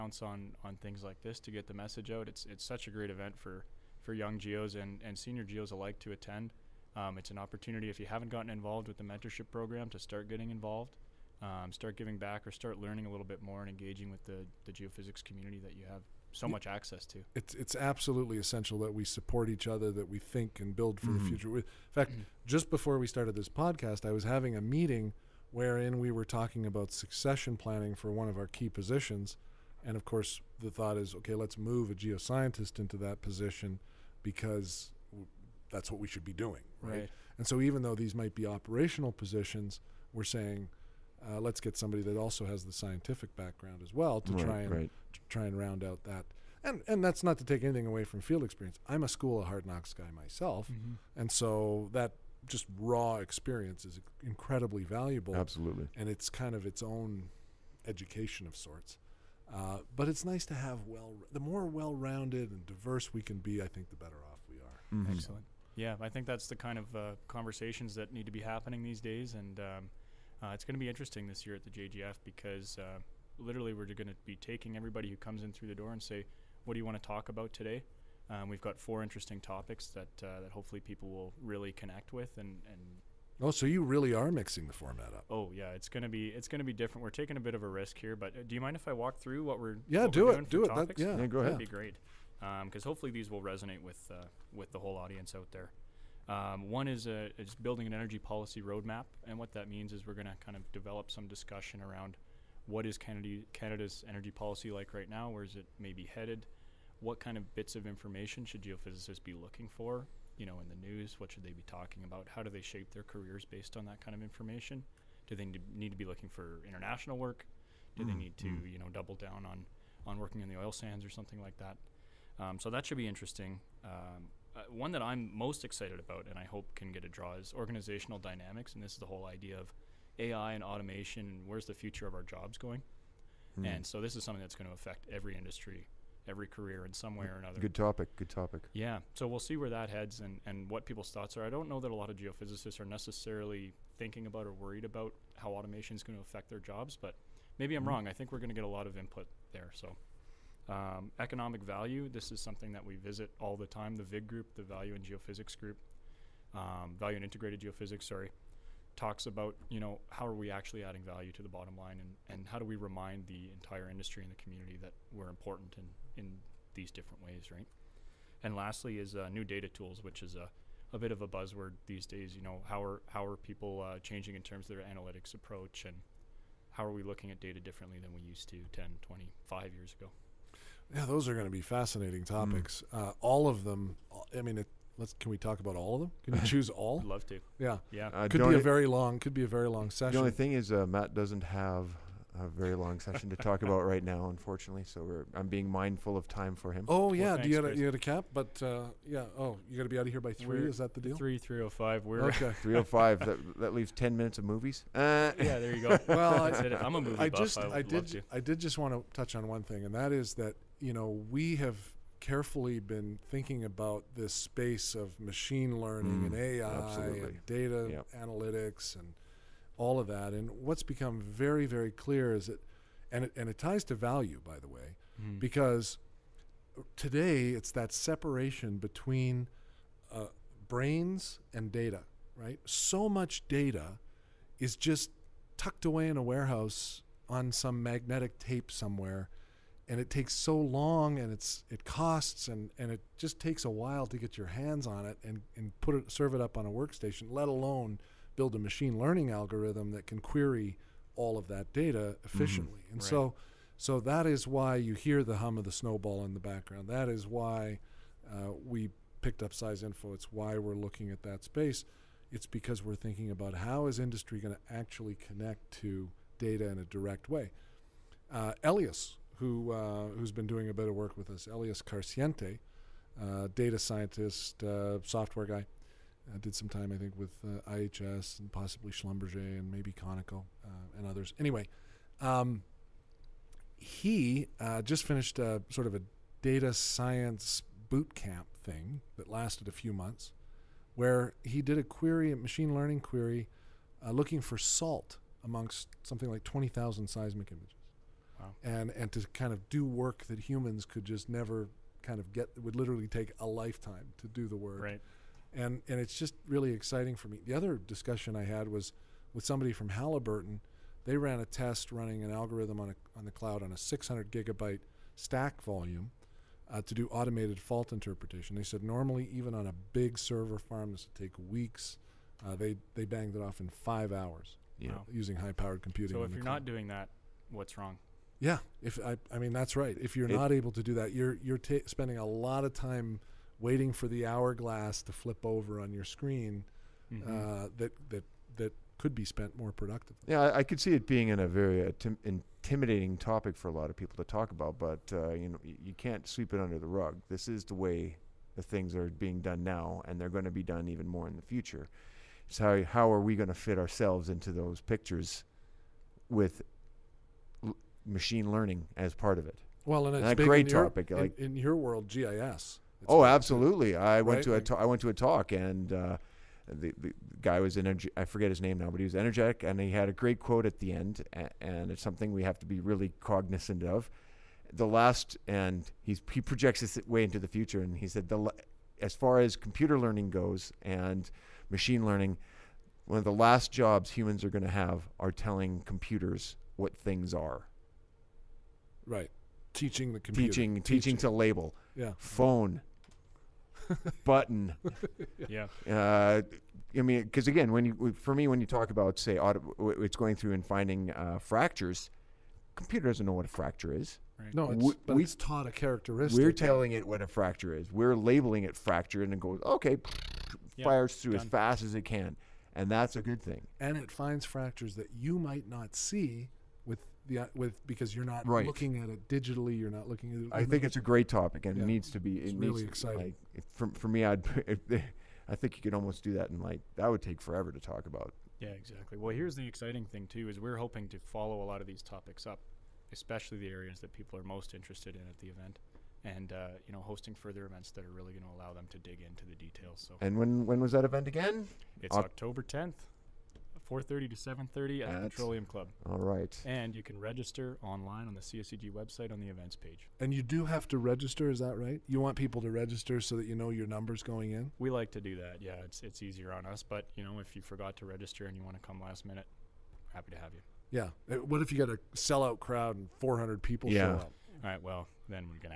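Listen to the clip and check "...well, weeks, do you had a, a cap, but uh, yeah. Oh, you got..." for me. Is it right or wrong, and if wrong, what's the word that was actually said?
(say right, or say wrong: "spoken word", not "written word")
wrong: "thanks", not "weeks".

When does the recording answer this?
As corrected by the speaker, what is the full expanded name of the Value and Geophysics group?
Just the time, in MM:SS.
02:36.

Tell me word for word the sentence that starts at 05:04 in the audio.
Right and and it's just really exciting for me.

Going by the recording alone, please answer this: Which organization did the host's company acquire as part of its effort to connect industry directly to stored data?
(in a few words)
SeisInfo.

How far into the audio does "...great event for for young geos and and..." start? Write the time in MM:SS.
00:02.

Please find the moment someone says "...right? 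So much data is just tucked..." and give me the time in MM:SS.
03:52.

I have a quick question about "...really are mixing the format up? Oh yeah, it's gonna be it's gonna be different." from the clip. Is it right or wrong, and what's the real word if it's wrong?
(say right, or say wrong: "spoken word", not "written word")
right.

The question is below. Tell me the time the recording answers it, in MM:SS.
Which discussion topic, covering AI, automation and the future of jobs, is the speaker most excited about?
02:07.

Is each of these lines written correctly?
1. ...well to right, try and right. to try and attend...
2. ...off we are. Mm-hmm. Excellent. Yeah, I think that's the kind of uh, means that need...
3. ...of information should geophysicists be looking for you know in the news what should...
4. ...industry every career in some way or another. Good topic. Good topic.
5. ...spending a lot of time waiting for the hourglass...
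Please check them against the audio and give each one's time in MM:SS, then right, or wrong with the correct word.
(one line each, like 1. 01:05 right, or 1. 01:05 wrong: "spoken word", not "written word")
1. 00:43 wrong: "round", not "attend"
2. 01:04 wrong: "conversations", not "means"
3. 01:47 right
4. 02:15 right
5. 05:31 right.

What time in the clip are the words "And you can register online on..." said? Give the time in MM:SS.
07:26.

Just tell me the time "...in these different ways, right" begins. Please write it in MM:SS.
02:46.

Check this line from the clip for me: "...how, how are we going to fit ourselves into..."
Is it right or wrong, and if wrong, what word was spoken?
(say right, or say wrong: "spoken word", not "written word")
right.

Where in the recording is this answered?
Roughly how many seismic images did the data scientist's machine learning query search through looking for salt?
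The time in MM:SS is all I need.
04:56.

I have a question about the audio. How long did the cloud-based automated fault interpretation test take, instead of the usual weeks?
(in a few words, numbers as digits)
5 hours.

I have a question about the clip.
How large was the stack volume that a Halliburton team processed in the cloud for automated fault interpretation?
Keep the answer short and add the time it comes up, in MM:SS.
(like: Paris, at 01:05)
600 gigabytes, at 05:13.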